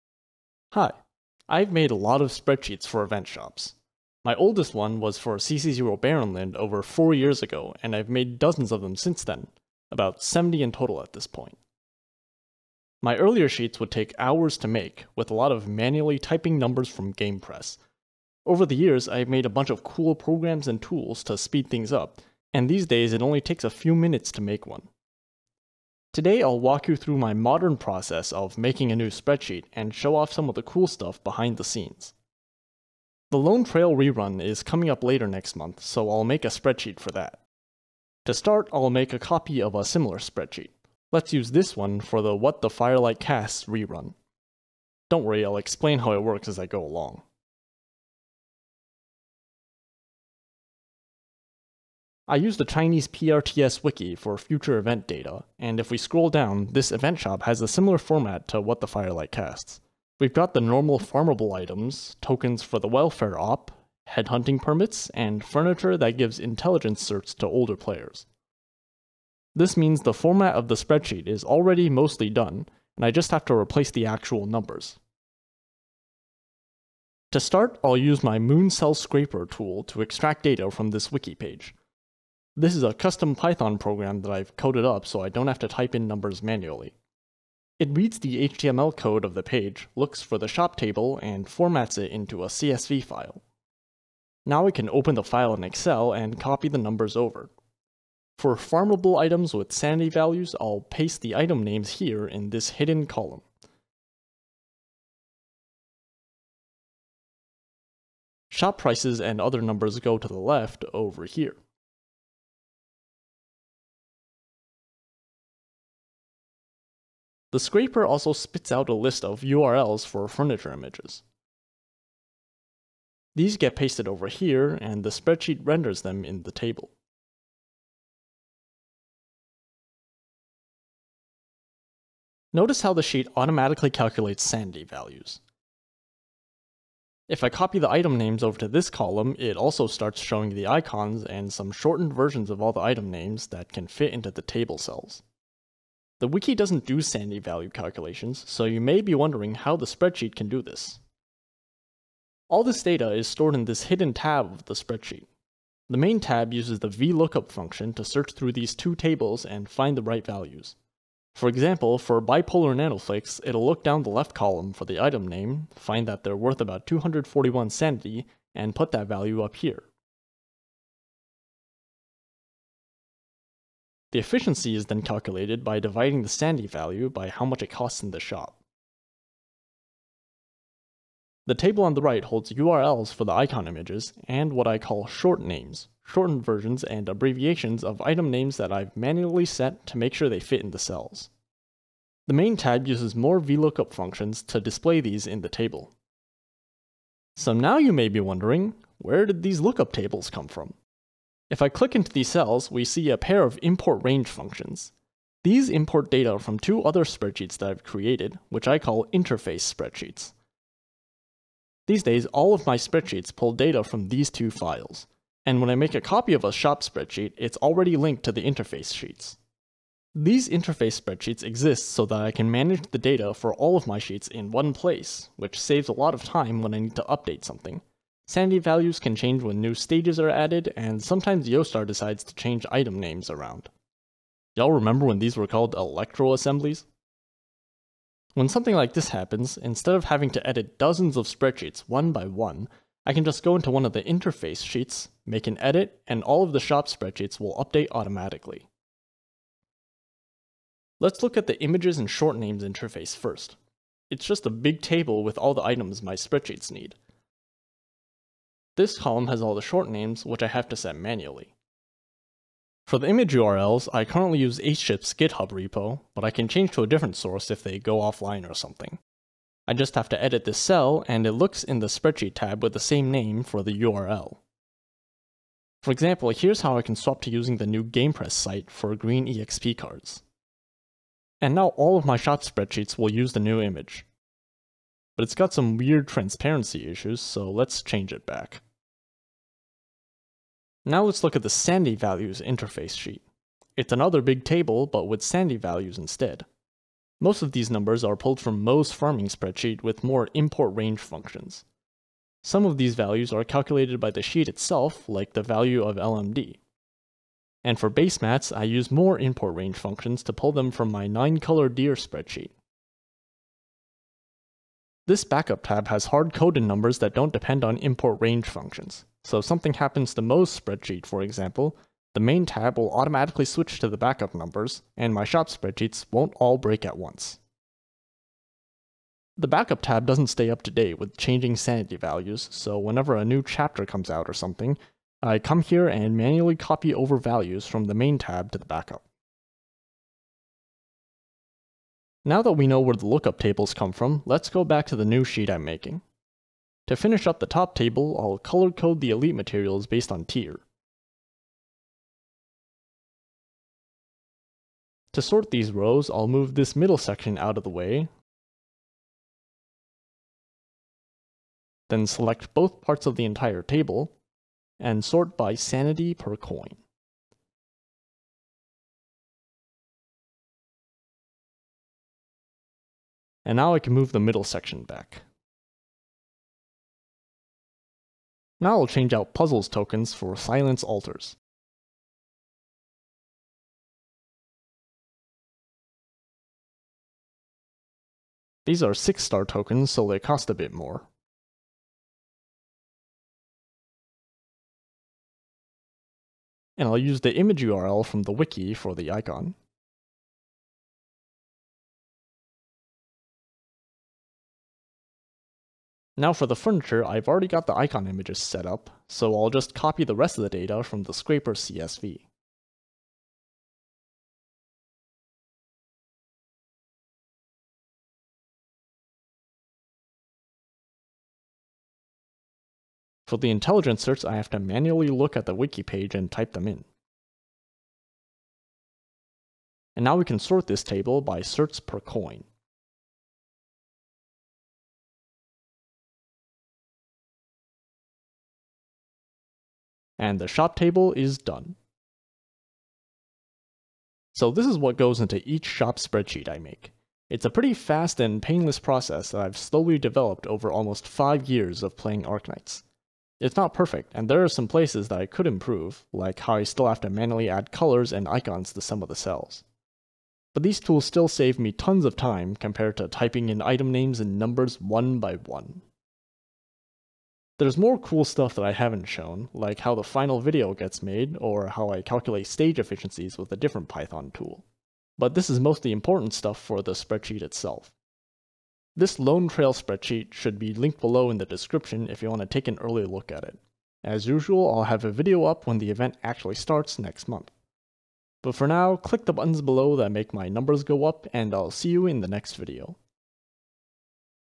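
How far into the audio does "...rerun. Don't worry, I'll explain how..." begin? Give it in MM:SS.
00:43.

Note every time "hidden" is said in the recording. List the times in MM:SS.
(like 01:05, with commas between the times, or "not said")
01:42, 02:33.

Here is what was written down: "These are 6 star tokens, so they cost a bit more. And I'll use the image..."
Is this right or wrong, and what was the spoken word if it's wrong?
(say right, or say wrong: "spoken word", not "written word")
right.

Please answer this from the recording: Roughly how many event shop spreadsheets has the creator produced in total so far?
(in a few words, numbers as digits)
70.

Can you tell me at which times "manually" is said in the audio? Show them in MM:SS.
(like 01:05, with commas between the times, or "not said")
00:15, 01:26, 03:08, 04:20, 05:36, 07:04, 07:37.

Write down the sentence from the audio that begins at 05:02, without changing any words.
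Some of these values are calculated by the sheet itself, like the value of LMD.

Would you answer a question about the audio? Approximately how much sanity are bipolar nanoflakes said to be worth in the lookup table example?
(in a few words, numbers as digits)
241.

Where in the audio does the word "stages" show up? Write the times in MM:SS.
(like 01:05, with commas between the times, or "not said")
03:49, 07:52.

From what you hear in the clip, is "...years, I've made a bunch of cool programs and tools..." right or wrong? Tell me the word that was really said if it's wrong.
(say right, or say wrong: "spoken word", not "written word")
right.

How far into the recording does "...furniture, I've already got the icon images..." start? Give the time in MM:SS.
06:46.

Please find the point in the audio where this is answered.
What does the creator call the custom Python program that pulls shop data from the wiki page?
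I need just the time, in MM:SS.
01:18.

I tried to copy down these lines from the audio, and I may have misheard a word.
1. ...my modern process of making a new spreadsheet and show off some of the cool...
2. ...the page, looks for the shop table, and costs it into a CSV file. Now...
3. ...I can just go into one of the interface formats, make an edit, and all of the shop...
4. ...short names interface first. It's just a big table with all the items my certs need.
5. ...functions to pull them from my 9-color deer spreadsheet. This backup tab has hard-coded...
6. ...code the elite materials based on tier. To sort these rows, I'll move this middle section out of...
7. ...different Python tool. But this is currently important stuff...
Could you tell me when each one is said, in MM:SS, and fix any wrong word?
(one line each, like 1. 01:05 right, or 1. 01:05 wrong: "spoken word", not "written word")
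1. 00:27 right
2. 01:29 wrong: "formats", not "costs"
3. 04:03 wrong: "sheets", not "formats"
4. 04:12 wrong: "spreadsheets", not "certs"
5. 05:09 right
6. 05:48 right
7. 07:53 wrong: "mostly", not "currently".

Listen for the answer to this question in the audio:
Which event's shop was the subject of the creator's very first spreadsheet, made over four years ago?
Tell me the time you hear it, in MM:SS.
00:05.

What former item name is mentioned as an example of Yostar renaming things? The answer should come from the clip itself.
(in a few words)
electro assemblies.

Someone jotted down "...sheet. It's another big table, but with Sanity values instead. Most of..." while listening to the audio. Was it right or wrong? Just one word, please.
right.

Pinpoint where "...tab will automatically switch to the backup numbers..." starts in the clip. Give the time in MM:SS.
05:22.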